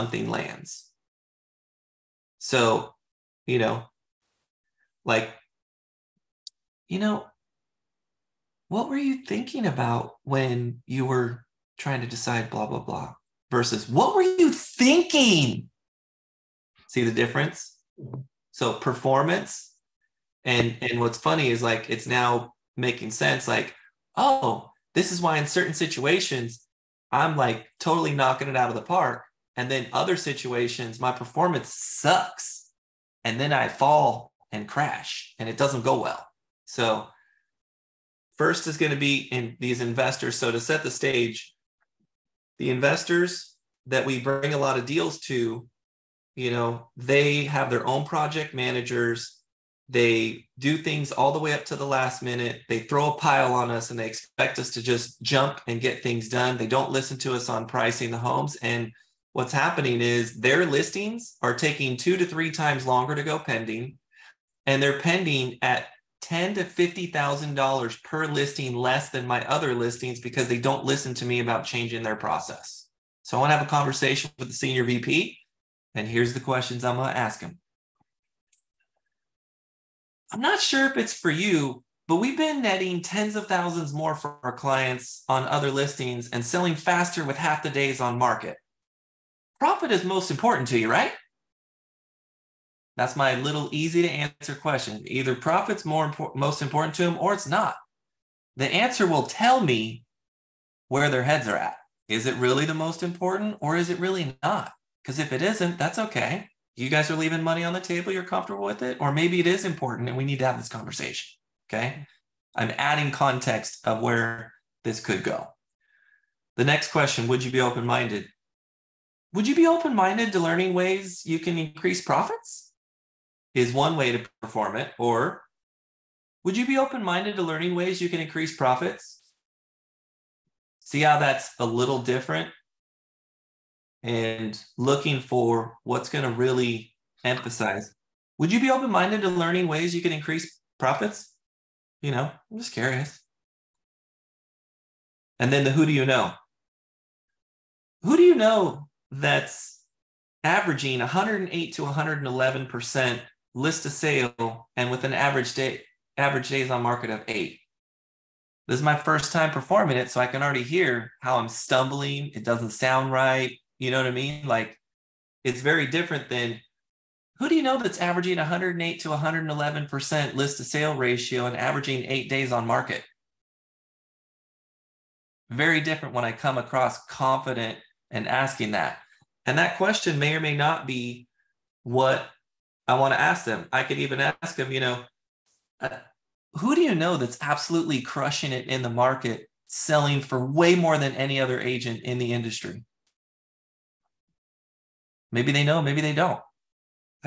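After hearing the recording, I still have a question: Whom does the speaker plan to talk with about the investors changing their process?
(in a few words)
The senior VP.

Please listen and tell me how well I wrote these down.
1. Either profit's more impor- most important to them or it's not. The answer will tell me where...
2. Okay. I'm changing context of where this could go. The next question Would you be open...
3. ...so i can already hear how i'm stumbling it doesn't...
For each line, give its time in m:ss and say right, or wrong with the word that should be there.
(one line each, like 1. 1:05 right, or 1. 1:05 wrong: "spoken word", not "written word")
1. 1:35 right
2. 1:51 wrong: "adding", not "changing"
3. 2:40 right.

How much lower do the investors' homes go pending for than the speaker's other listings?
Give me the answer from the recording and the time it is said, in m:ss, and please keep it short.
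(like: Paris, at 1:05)
10 to 50 thousand dollars, at 1:06.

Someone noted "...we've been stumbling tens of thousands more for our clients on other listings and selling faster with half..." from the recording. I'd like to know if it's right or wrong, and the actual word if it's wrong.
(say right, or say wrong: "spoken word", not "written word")
wrong: "netting", not "stumbling".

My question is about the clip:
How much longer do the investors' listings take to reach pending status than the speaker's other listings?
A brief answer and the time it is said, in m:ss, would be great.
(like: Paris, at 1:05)
2 to 3 times longer, at 1:01.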